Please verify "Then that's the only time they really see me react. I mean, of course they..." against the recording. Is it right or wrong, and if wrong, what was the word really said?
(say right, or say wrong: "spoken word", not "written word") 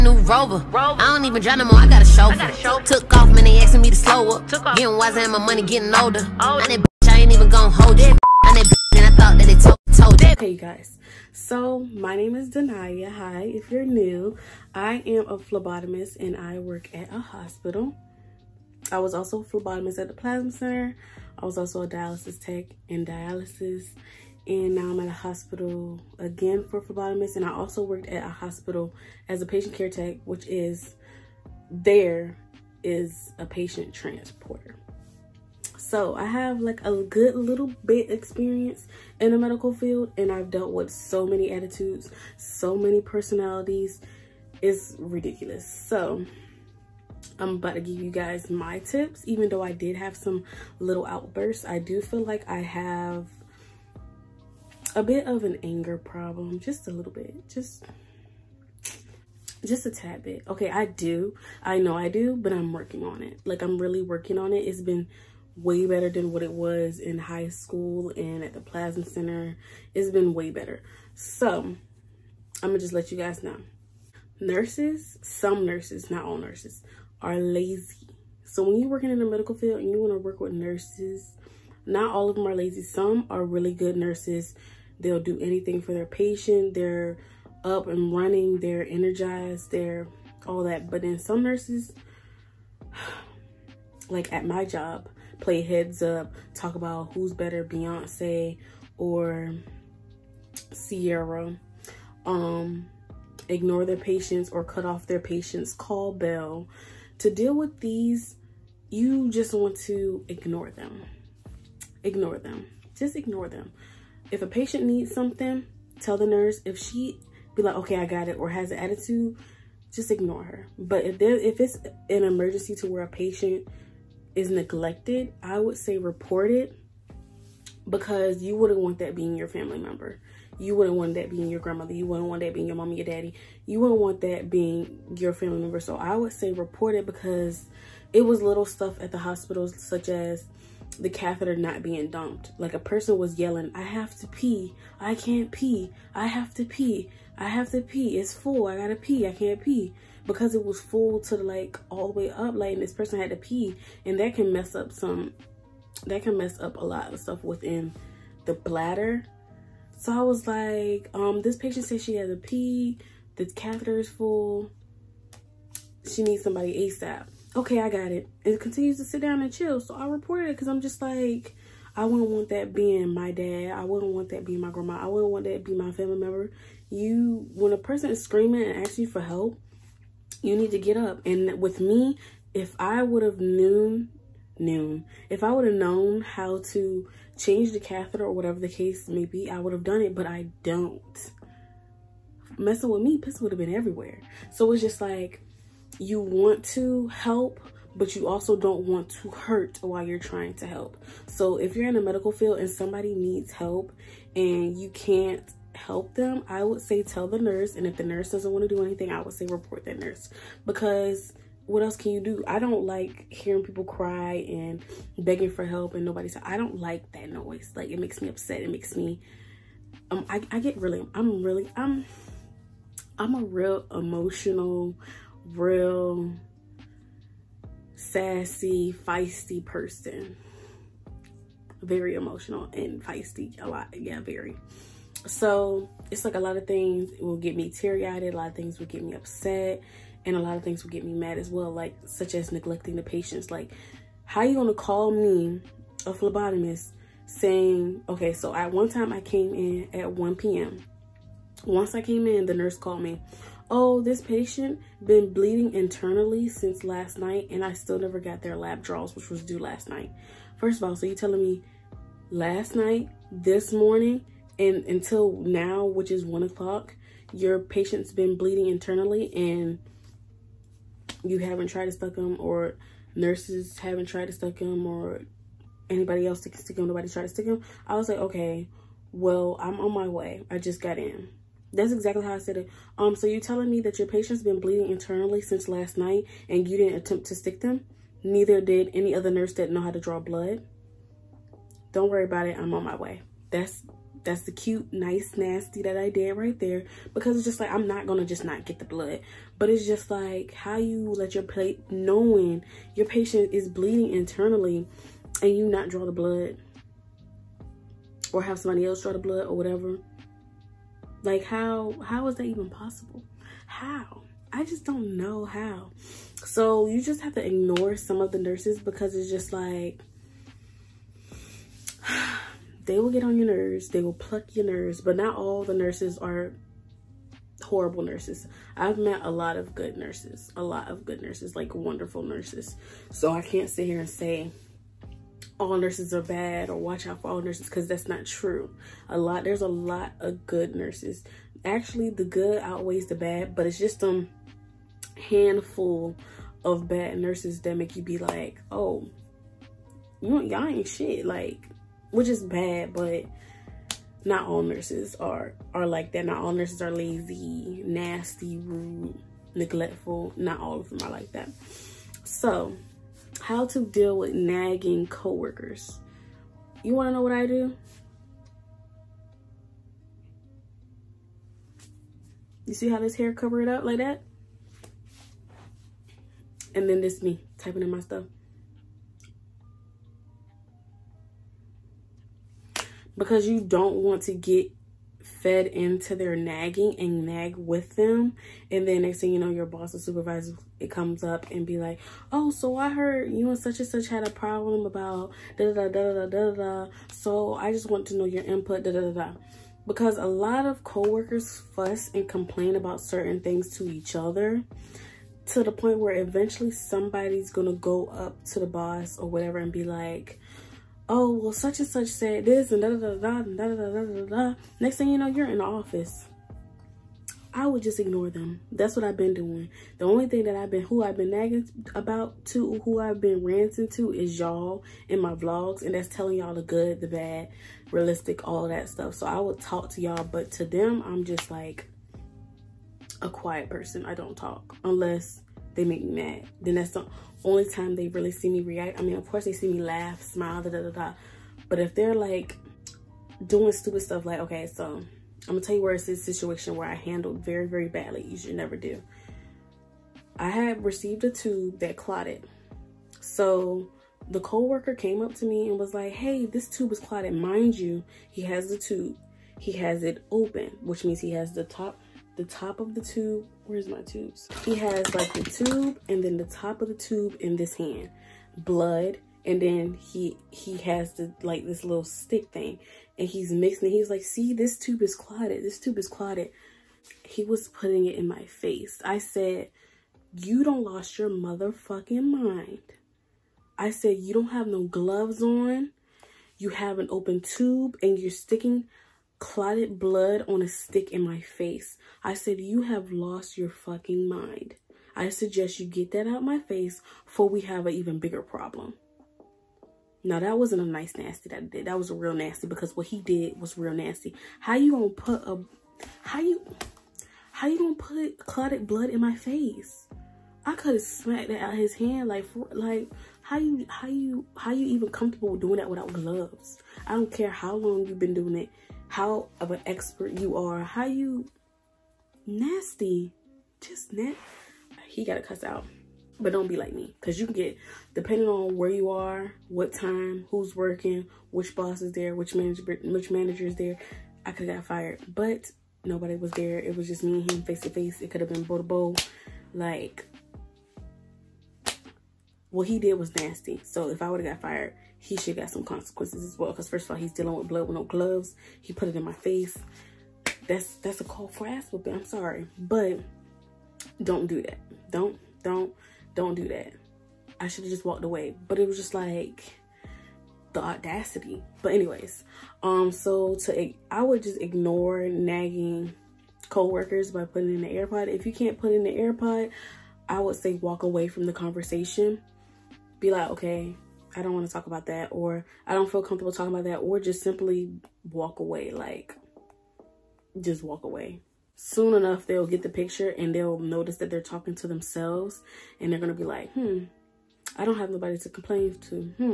right.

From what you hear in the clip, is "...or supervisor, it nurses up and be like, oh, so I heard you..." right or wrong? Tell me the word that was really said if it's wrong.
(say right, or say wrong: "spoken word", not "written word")
wrong: "comes", not "nurses".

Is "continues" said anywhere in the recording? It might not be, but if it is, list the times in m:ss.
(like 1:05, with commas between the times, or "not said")
2:48.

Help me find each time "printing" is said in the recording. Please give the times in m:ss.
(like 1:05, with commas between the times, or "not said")
not said.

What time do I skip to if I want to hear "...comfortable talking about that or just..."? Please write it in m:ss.
9:36.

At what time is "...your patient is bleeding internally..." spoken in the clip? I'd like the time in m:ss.
5:02.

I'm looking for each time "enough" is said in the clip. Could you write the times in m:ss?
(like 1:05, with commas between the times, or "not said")
9:42.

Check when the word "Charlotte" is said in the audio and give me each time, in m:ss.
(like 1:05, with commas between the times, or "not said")
not said.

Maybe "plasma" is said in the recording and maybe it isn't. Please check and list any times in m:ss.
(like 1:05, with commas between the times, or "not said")
0:20, 1:08.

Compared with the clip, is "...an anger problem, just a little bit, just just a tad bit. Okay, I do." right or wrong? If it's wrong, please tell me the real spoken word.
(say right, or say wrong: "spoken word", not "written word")
right.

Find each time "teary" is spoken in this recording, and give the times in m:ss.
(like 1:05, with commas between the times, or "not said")
3:57.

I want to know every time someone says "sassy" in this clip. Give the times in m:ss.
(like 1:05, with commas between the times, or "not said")
3:47.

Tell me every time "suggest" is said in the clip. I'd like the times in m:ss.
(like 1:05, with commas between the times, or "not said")
8:15.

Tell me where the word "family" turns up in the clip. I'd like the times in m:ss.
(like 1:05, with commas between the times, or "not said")
2:09, 2:15, 2:55.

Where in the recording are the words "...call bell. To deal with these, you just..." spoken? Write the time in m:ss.
1:45.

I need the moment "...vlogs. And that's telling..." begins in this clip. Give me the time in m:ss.
7:05.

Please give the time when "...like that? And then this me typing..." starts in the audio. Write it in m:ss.
6:13.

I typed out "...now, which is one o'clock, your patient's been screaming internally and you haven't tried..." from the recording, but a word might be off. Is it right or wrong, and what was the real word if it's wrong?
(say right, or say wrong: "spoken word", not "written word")
wrong: "bleeding", not "screaming".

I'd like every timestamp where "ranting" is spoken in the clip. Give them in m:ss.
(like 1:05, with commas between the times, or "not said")
7:03.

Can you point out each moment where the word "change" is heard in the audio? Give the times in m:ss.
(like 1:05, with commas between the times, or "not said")
3:07.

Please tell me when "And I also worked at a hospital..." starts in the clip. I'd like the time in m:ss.
0:27.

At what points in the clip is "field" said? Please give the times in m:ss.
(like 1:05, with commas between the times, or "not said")
0:39, 1:19, 3:22.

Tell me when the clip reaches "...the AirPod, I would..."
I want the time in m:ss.
9:29.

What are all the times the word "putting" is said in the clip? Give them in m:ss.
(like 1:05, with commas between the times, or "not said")
7:57, 9:27.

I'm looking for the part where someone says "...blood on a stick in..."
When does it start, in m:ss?
8:09.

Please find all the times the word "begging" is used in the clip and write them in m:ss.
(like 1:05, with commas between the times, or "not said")
3:35.